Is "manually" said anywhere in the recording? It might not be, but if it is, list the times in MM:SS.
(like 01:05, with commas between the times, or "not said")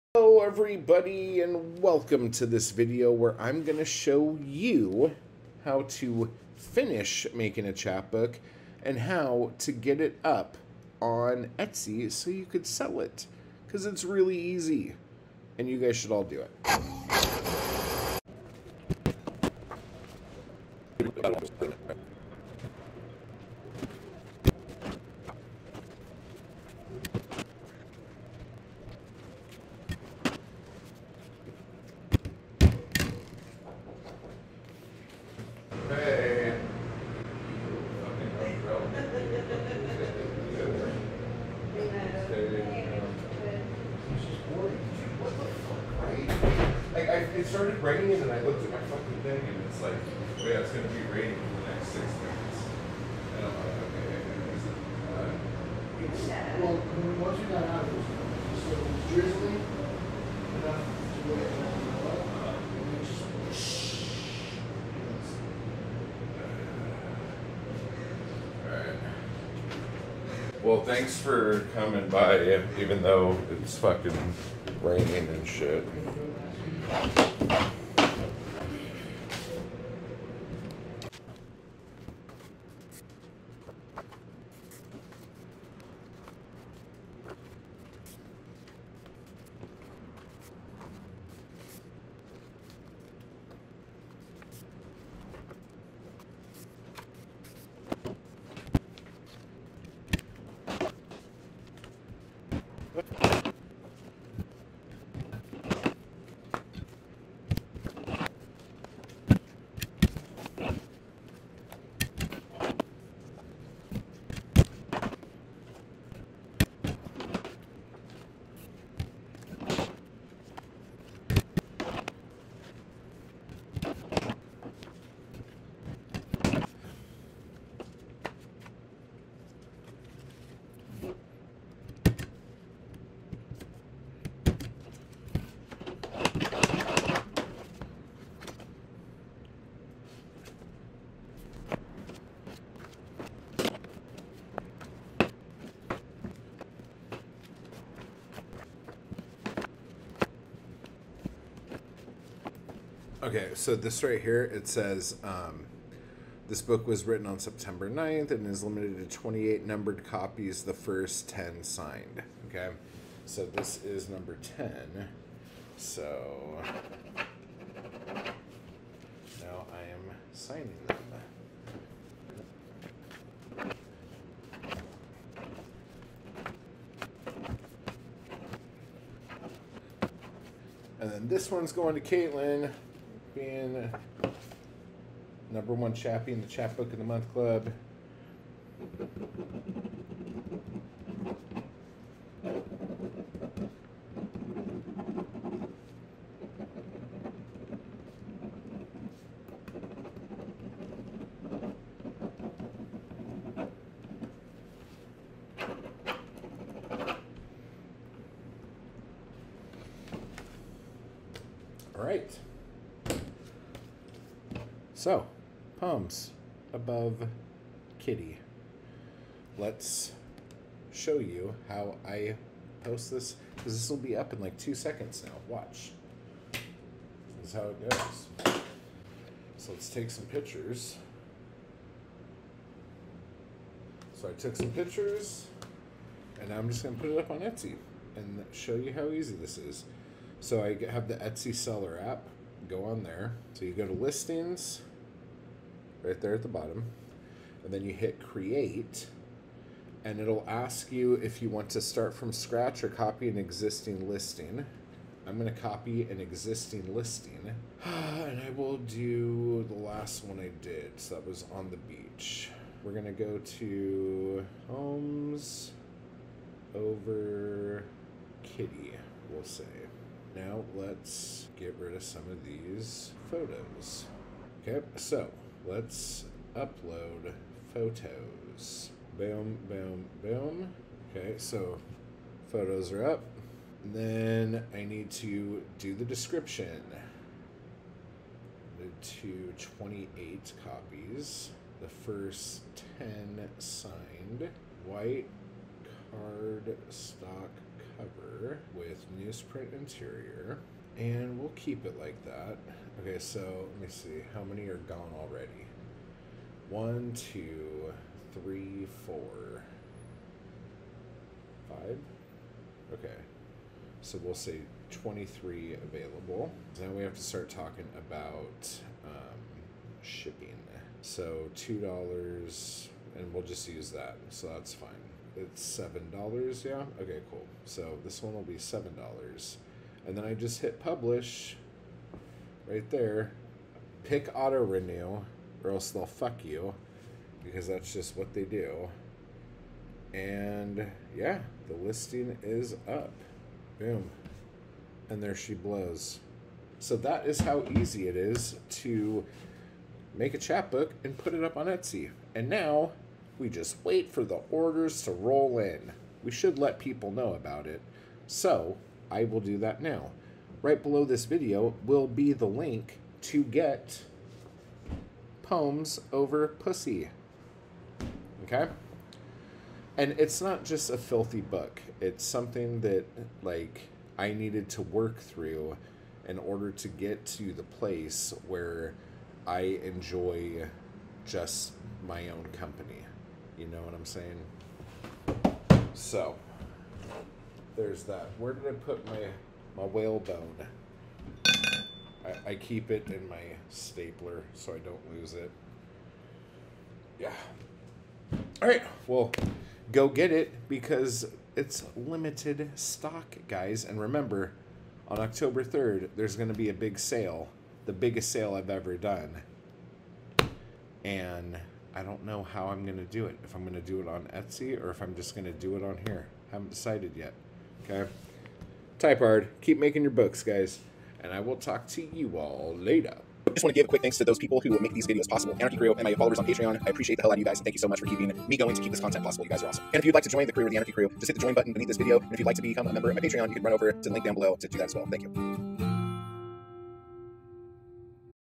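not said.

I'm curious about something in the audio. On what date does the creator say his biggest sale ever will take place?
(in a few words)
October 3.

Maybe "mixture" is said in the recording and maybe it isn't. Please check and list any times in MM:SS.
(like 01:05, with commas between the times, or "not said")
not said.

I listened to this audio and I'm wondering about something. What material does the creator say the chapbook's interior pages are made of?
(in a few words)
Newsprint.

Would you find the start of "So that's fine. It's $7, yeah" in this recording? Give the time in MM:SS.
05:24.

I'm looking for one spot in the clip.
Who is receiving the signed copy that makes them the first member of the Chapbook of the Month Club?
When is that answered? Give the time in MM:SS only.
03:02.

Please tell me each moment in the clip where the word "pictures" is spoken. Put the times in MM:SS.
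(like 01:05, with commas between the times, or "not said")
03:50, 03:54.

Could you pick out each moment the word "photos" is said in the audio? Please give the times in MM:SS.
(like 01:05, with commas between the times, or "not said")
04:33, 04:37, 04:42.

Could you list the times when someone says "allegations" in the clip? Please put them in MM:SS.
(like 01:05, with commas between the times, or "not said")
not said.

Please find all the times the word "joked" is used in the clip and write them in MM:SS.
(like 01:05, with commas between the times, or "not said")
not said.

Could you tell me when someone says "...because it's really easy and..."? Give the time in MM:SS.
00:13.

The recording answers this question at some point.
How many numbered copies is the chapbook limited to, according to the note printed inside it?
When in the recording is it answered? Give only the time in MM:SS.
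02:39.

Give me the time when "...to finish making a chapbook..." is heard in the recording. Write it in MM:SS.
00:05.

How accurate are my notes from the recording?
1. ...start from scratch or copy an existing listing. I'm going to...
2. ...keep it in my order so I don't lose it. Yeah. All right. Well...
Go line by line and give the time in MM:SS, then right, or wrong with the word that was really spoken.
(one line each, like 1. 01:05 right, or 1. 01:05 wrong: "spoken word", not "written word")
1. 04:11 right
2. 06:32 wrong: "stapler", not "order".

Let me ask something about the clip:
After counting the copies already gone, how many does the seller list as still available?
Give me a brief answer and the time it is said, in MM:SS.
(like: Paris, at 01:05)
23, at 05:14.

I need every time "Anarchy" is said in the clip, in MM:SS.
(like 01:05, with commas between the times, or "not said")
07:05, 07:10.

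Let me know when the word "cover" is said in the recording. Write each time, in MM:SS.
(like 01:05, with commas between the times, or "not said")
04:57.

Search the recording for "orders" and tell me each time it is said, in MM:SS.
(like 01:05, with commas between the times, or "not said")
05:54, 06:16.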